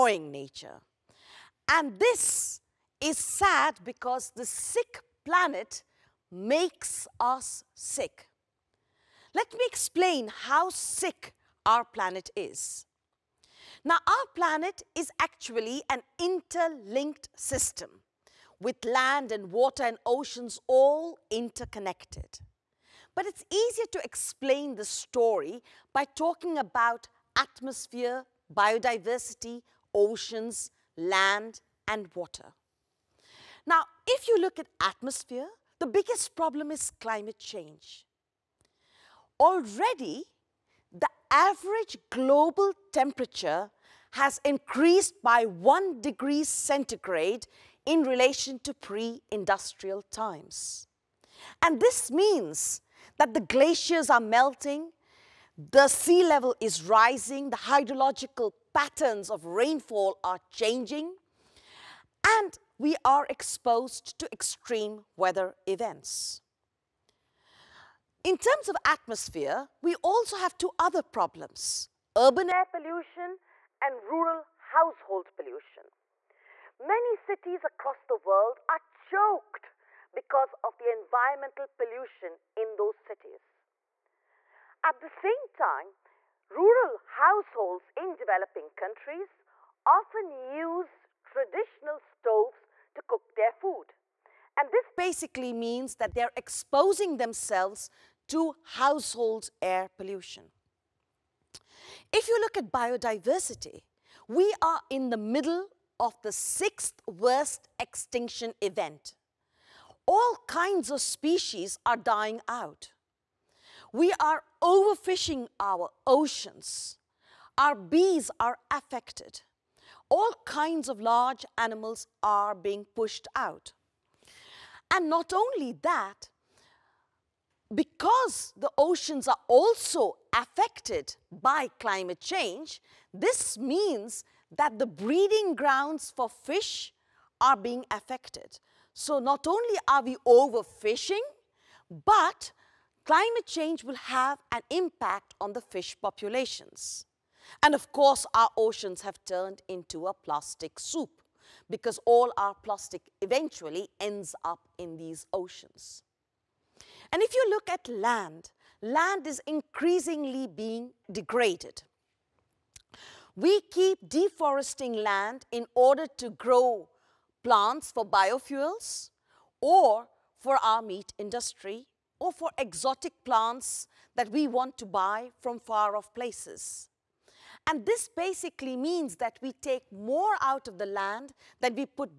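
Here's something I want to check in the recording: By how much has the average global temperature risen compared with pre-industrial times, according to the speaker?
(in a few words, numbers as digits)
1 degree centigrade.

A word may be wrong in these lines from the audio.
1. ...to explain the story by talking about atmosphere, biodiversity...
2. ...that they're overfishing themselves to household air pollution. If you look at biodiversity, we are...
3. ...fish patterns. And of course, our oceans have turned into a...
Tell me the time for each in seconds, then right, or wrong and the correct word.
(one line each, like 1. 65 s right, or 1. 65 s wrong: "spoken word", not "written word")
1. 23 s right
2. 95 s wrong: "exposing", not "overfishing"
3. 145 s wrong: "populations", not "patterns".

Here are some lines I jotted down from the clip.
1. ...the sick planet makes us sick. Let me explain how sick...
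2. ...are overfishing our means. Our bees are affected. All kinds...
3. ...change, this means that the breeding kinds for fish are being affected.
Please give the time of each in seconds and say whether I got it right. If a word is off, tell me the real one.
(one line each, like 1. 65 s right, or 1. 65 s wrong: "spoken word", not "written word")
1. 4 s right
2. 114 s wrong: "oceans", not "means"
3. 132 s wrong: "grounds", not "kinds".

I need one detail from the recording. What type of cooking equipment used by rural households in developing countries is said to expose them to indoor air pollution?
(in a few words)
traditional stoves.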